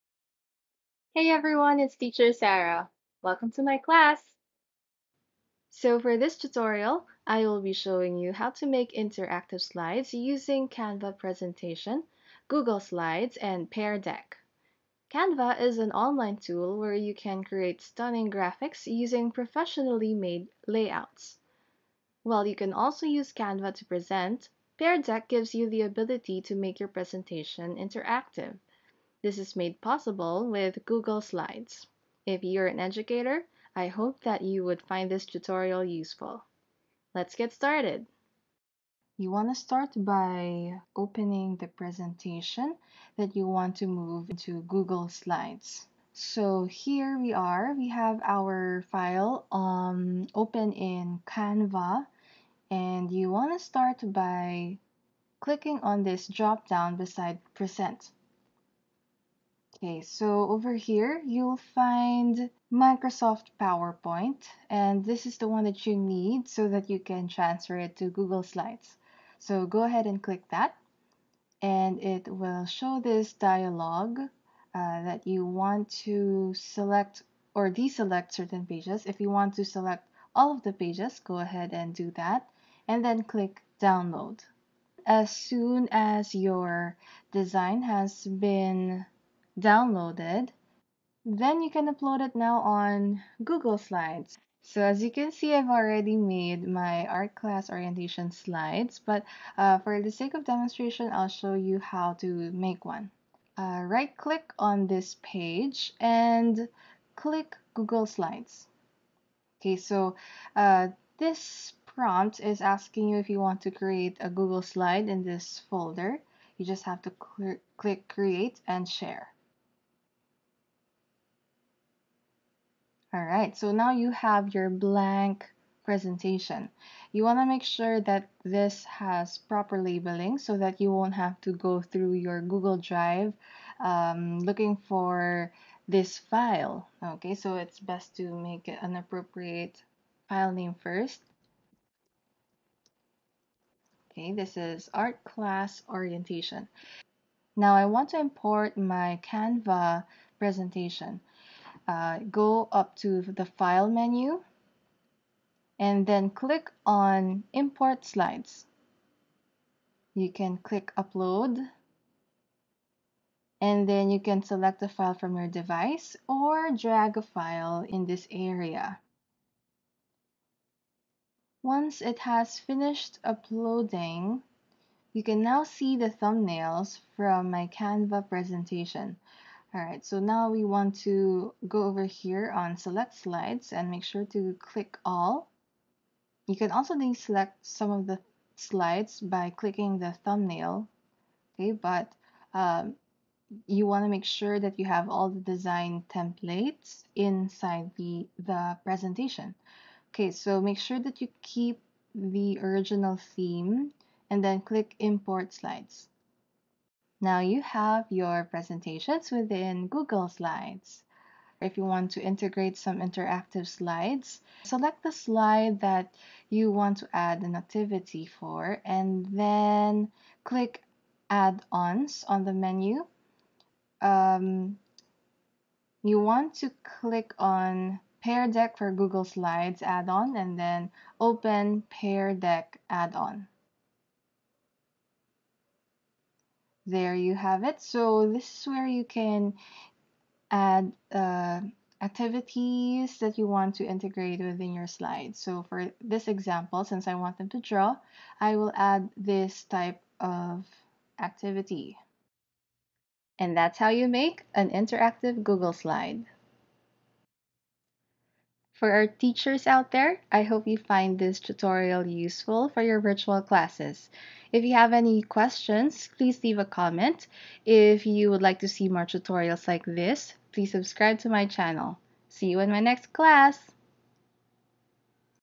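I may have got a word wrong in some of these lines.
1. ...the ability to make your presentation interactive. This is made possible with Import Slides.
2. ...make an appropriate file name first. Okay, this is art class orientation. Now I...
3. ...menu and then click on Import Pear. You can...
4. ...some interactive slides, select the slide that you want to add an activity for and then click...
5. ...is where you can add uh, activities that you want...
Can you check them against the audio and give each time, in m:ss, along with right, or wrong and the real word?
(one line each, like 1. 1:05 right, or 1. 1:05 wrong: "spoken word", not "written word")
1. 0:25 wrong: "Google", not "Import"
2. 2:18 right
3. 2:33 wrong: "Slides", not "Pear"
4. 3:32 right
5. 3:58 right.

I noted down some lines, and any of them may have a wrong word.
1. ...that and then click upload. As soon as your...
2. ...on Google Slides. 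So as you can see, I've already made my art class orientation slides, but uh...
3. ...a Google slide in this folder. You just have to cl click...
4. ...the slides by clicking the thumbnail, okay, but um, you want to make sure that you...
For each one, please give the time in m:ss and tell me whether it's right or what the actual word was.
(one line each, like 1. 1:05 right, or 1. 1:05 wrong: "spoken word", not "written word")
1. 1:22 wrong: "download", not "upload"
2. 1:32 right
3. 1:54 right
4. 3:08 right.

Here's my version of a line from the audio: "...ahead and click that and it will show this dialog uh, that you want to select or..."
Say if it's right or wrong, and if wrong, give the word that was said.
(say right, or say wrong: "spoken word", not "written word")
right.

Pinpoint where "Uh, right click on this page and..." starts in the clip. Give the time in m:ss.
1:43.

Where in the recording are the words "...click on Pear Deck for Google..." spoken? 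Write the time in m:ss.
3:46.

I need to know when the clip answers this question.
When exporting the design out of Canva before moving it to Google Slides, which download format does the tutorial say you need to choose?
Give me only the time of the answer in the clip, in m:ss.
1:02.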